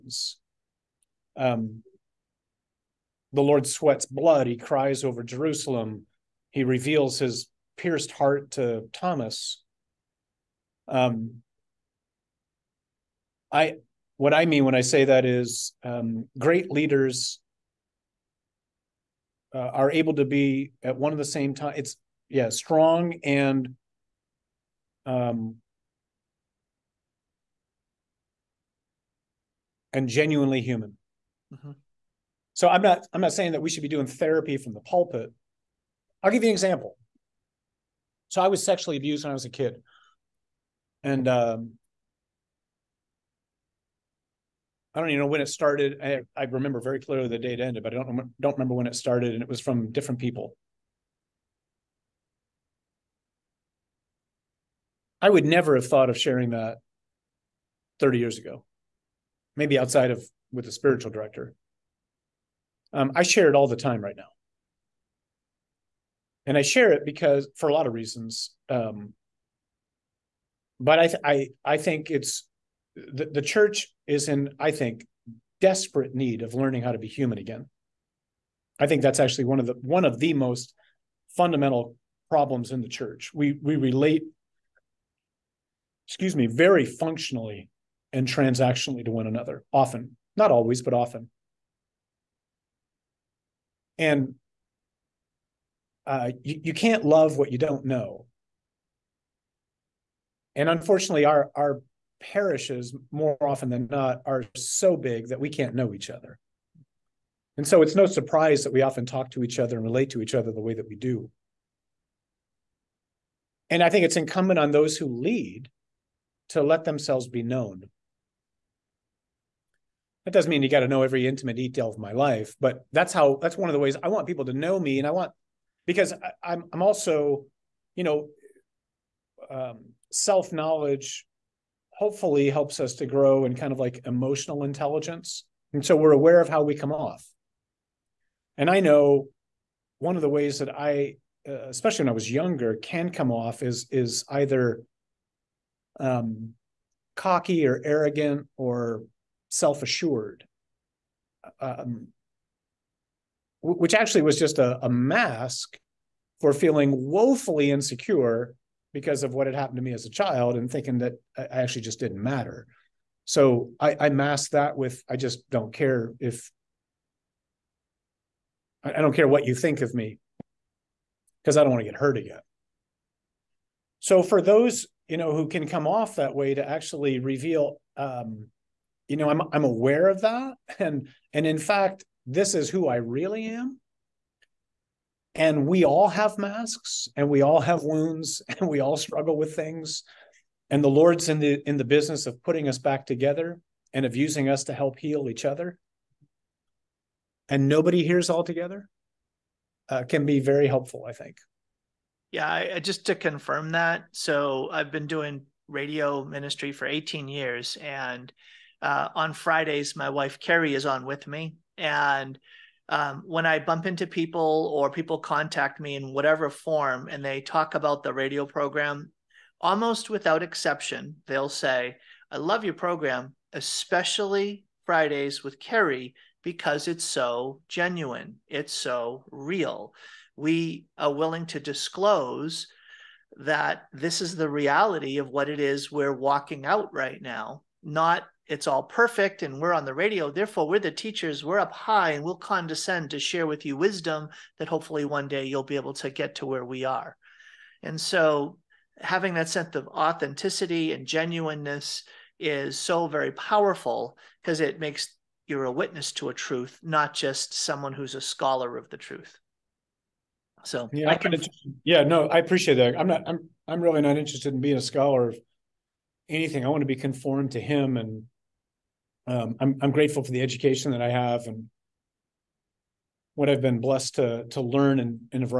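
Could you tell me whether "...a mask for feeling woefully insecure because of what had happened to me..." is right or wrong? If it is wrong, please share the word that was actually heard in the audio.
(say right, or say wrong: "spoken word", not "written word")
right.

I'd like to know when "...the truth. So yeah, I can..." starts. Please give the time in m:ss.
4:18.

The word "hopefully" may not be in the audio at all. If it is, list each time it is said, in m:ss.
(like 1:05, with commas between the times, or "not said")
2:11, 4:04.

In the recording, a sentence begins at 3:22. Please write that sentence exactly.
Yeah, I, I, just to confirm that.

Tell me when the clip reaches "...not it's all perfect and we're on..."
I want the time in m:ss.
3:57.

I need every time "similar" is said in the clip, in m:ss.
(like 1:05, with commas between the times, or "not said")
not said.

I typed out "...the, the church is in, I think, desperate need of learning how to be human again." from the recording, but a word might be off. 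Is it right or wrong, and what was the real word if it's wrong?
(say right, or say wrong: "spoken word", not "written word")
right.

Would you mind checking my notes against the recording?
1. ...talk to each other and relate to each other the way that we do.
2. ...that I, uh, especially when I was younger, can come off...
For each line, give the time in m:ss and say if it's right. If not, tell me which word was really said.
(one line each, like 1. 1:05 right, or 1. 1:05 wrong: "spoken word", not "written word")
1. 1:49 right
2. 2:20 right.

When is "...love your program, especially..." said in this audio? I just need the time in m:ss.
3:42.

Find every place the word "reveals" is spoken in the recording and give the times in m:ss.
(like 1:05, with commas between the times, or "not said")
0:06, 2:57.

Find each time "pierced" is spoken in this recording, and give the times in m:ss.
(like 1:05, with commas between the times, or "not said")
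0:07.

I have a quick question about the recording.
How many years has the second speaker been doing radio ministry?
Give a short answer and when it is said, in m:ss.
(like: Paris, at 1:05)
18 years, at 3:26.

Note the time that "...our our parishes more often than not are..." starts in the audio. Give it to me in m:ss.
1:41.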